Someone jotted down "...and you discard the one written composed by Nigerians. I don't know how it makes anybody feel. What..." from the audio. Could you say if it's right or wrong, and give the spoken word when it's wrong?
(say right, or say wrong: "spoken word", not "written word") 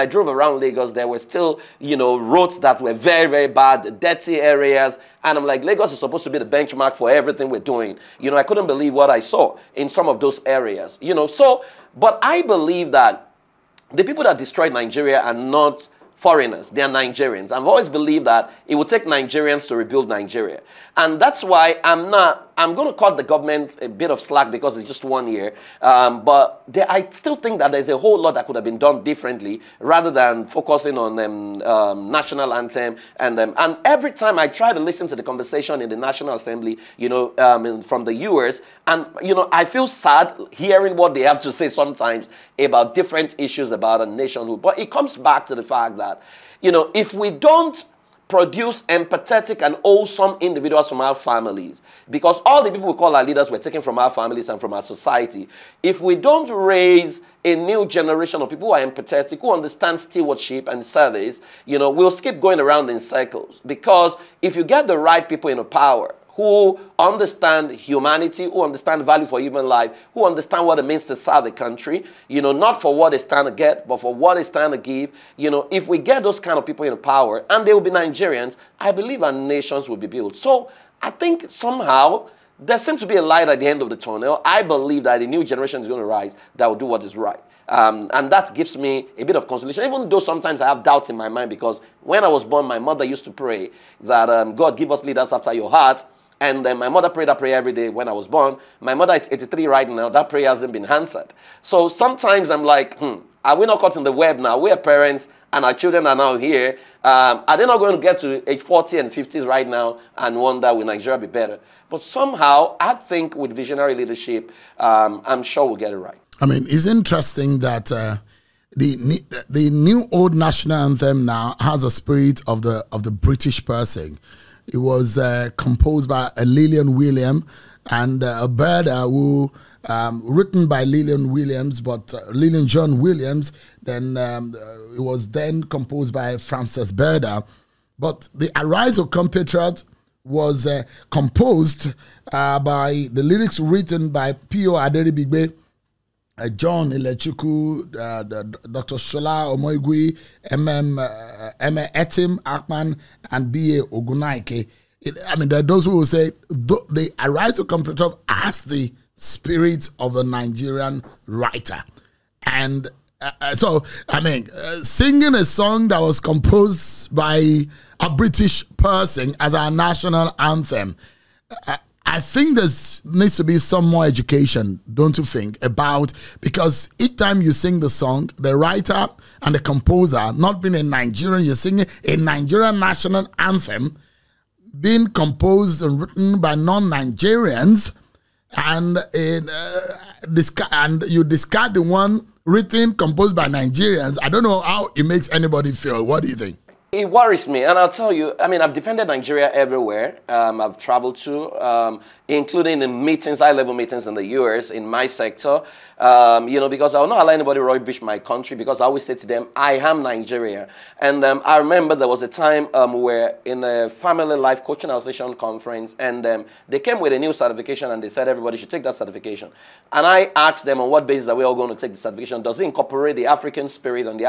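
right.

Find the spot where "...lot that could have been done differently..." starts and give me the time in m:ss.
0:28.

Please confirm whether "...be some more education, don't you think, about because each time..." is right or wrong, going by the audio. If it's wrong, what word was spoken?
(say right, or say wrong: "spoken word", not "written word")
right.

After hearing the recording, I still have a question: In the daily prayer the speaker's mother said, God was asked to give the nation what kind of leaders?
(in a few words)
Leaders after your heart.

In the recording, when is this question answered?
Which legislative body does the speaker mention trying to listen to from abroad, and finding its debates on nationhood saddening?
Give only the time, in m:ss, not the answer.
0:35.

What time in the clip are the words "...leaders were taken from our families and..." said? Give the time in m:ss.
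0:53.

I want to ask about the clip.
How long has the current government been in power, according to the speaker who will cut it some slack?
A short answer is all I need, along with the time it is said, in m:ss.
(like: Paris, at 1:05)
1 year, at 0:25.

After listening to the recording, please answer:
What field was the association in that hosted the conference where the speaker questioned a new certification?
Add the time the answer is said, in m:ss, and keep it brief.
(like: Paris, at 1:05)
Family life coaching, at 3:33.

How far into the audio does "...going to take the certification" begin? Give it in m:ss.
3:41.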